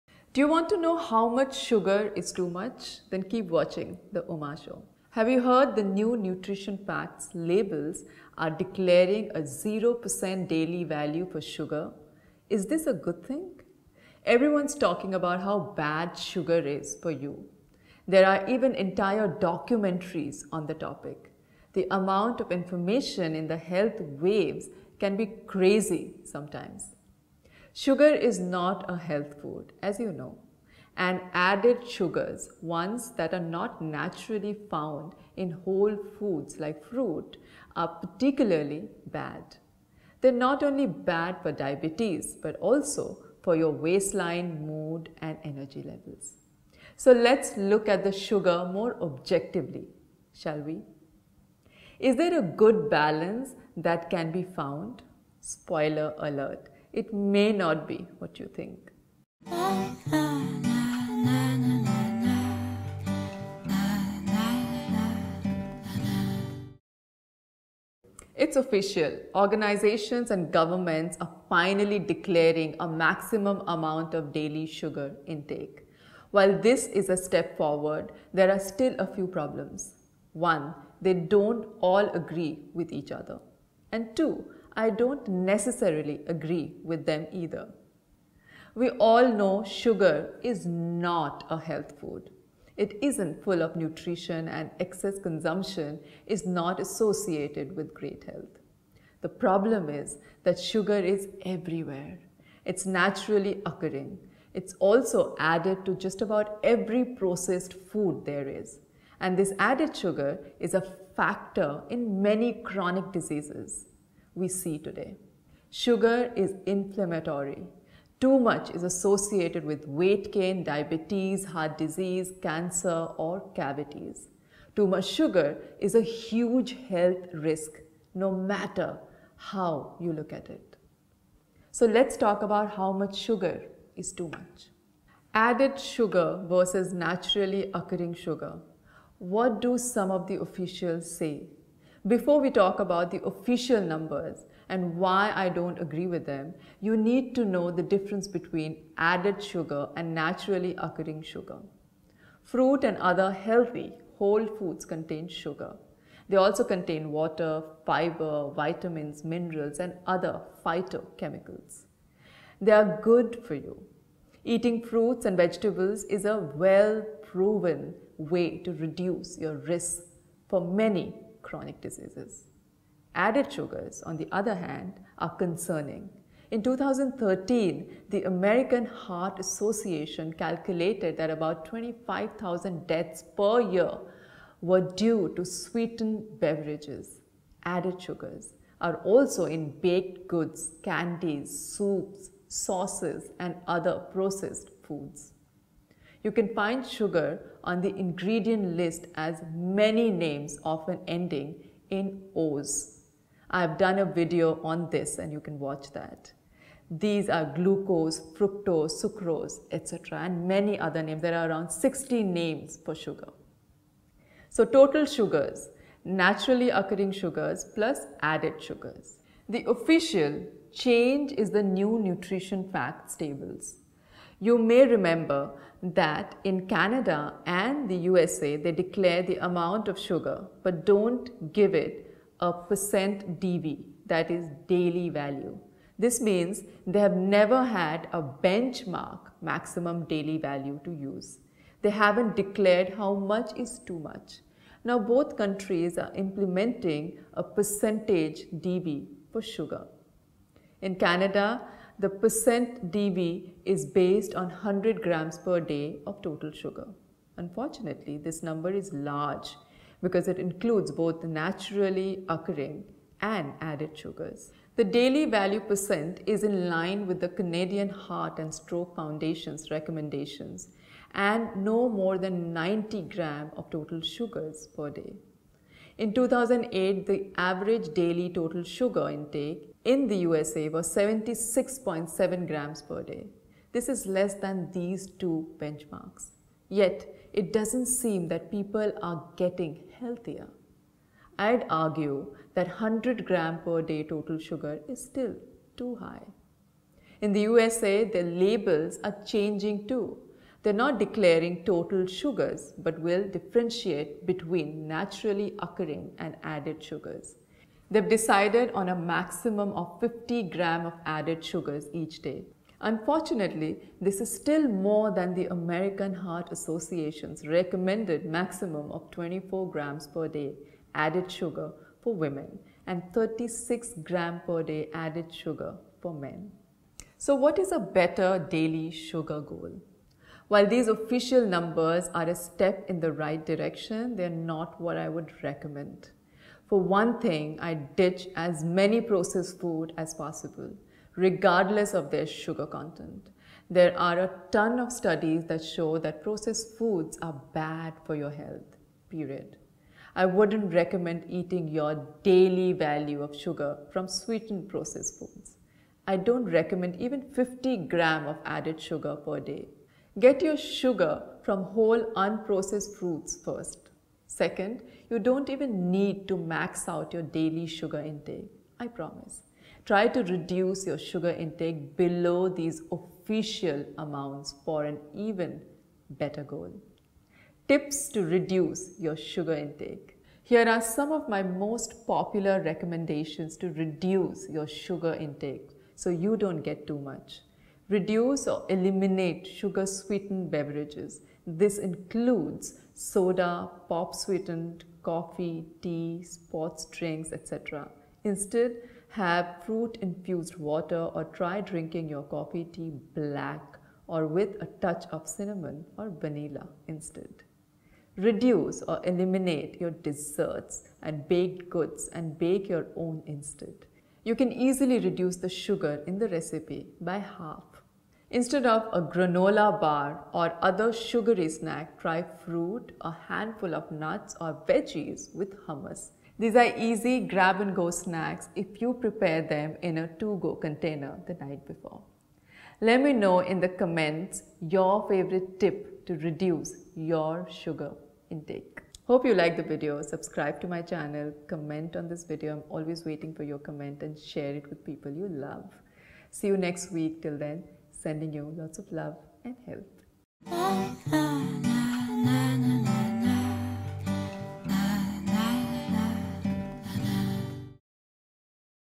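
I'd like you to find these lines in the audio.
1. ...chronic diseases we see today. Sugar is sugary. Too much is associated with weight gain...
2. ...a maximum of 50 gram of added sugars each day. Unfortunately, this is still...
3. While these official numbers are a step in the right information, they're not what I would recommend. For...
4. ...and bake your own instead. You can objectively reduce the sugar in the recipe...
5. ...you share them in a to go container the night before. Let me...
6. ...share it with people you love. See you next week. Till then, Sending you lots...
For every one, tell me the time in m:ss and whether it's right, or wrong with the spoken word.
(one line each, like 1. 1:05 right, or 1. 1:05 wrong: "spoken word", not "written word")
1. 1:52 wrong: "inflammatory", not "sugary"
2. 5:08 right
3. 5:30 wrong: "direction", not "information"
4. 6:52 wrong: "easily", not "objectively"
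5. 7:08 wrong: "prepare", not "share"
6. 7:24 right.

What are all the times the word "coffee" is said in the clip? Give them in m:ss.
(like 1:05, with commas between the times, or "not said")
6:35, 6:42.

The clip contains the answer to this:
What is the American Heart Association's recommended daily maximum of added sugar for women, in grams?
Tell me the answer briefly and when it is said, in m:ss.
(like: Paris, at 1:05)
24 grams, at 5:19.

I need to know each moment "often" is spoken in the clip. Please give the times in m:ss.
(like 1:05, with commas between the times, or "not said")
3:20.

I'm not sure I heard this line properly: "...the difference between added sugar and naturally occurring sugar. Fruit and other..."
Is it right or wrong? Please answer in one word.
right.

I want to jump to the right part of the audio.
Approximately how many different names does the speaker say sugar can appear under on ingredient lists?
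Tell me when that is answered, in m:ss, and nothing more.
3:31.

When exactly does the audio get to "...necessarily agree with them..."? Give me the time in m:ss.
1:25.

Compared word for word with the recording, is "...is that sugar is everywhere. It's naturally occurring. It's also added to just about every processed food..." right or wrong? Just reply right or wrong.
right.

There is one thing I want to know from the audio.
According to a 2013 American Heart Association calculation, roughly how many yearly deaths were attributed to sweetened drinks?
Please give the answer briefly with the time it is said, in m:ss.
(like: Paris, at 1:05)
25,000, at 3:01.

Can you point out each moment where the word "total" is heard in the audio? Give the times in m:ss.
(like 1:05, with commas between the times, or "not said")
3:34, 4:16, 4:33, 4:38, 4:54, 5:01.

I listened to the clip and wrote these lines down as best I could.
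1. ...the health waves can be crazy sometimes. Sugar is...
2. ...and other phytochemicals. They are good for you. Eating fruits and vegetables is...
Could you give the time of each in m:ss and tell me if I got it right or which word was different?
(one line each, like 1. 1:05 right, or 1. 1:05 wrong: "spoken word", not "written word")
1. 0:23 right
2. 2:39 right.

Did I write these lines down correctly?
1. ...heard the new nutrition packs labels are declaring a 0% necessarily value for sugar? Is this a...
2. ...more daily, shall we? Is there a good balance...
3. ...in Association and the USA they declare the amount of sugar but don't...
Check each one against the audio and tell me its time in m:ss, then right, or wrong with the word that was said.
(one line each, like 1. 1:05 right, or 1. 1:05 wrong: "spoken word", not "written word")
1. 0:05 wrong: "daily", not "necessarily"
2. 0:48 wrong: "objectively", not "daily"
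3. 3:46 wrong: "Canada", not "Association".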